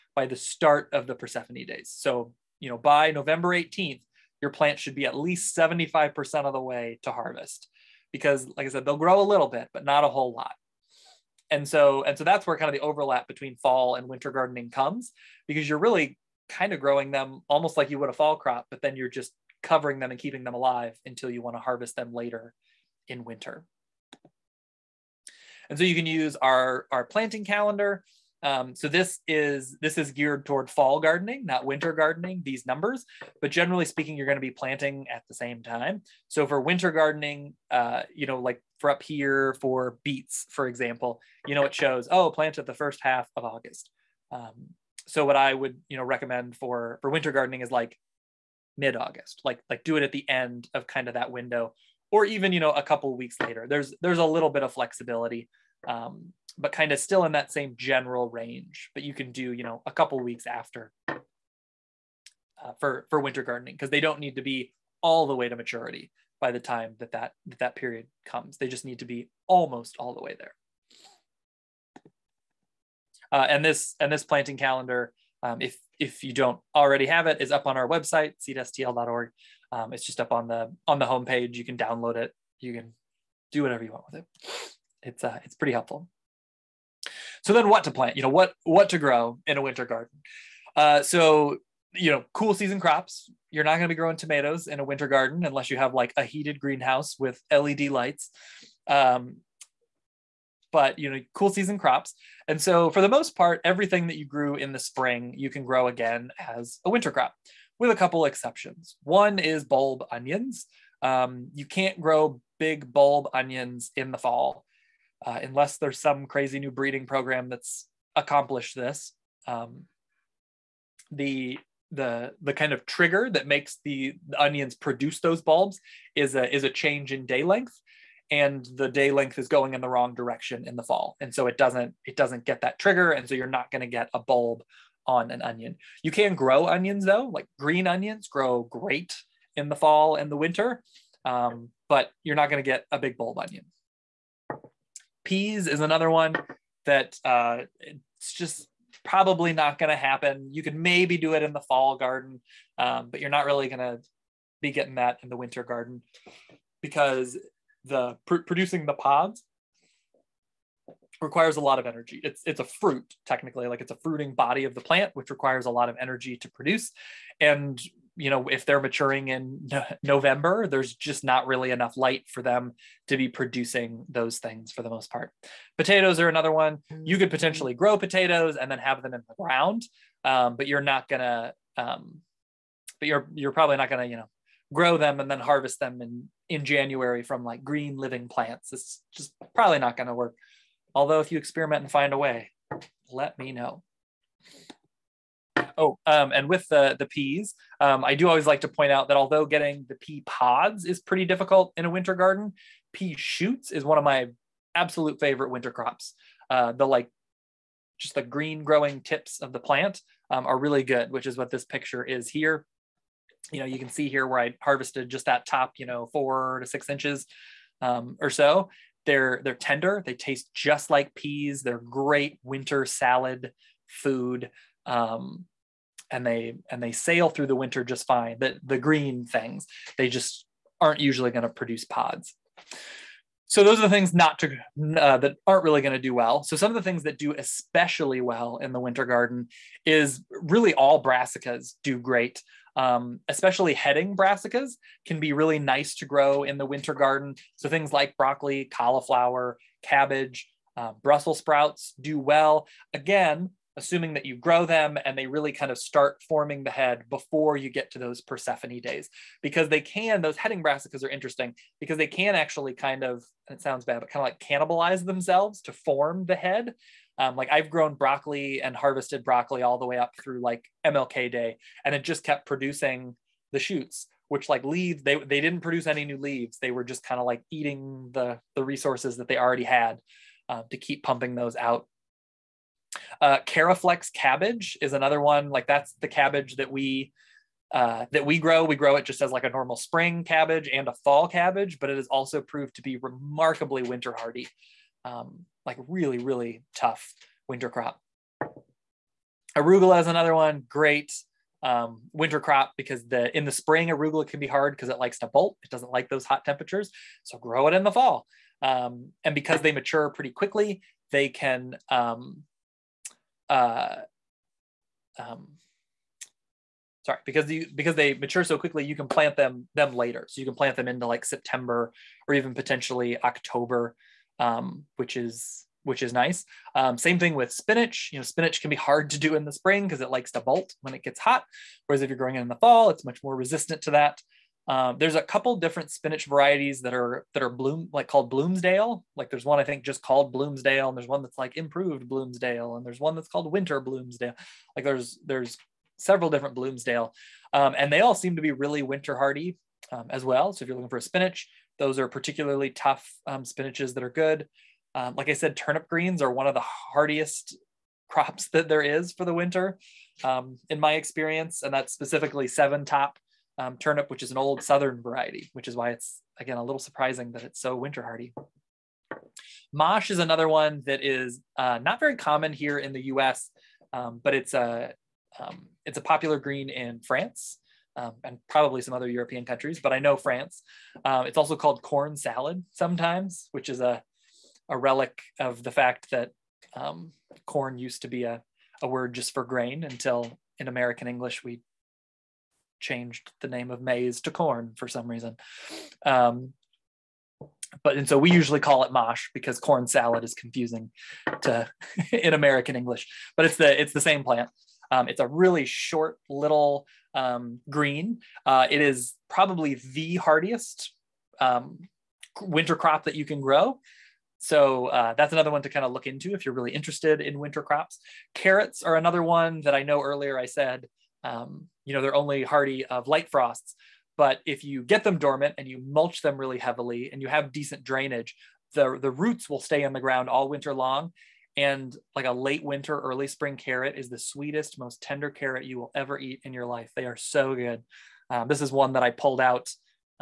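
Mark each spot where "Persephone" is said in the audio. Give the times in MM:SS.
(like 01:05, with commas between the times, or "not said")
00:01, 04:18.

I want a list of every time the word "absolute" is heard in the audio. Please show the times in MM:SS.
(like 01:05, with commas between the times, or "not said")
03:24.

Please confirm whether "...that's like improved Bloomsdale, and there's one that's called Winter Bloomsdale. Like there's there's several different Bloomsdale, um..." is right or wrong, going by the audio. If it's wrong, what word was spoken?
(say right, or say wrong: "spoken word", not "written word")
right.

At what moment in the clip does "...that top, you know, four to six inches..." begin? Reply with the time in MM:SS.
03:35.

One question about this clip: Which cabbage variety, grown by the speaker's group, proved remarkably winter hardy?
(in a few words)
Caraflex.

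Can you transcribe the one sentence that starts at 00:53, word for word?
There's there's a little bit of flexibility, um, but kind of still in that same general range.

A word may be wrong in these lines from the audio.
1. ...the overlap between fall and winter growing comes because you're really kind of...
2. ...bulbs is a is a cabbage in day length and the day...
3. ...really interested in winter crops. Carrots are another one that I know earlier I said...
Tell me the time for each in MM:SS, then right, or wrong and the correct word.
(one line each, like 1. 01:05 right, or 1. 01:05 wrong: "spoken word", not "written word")
1. 00:12 wrong: "gardening", not "growing"
2. 02:05 wrong: "change", not "cabbage"
3. 06:56 right.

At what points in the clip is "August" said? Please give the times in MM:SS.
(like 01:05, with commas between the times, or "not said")
00:43, 00:48.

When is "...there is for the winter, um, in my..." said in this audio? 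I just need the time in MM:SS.
05:58.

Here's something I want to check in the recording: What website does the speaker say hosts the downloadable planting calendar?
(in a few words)
seedstl.org.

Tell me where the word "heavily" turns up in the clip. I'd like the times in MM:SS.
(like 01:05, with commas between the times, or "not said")
07:06.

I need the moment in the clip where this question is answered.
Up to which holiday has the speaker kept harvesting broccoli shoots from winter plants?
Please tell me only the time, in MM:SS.
04:30.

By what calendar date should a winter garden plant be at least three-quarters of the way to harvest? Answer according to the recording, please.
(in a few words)
November 18th.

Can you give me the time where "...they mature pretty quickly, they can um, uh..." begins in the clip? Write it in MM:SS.
05:09.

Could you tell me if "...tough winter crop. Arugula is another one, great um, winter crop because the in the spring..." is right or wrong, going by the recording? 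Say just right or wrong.
right.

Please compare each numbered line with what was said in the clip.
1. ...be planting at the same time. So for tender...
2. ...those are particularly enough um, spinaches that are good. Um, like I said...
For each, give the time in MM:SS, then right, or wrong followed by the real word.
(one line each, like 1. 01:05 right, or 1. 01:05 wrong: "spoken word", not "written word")
1. 00:34 wrong: "winter", not "tender"
2. 05:51 wrong: "tough", not "enough".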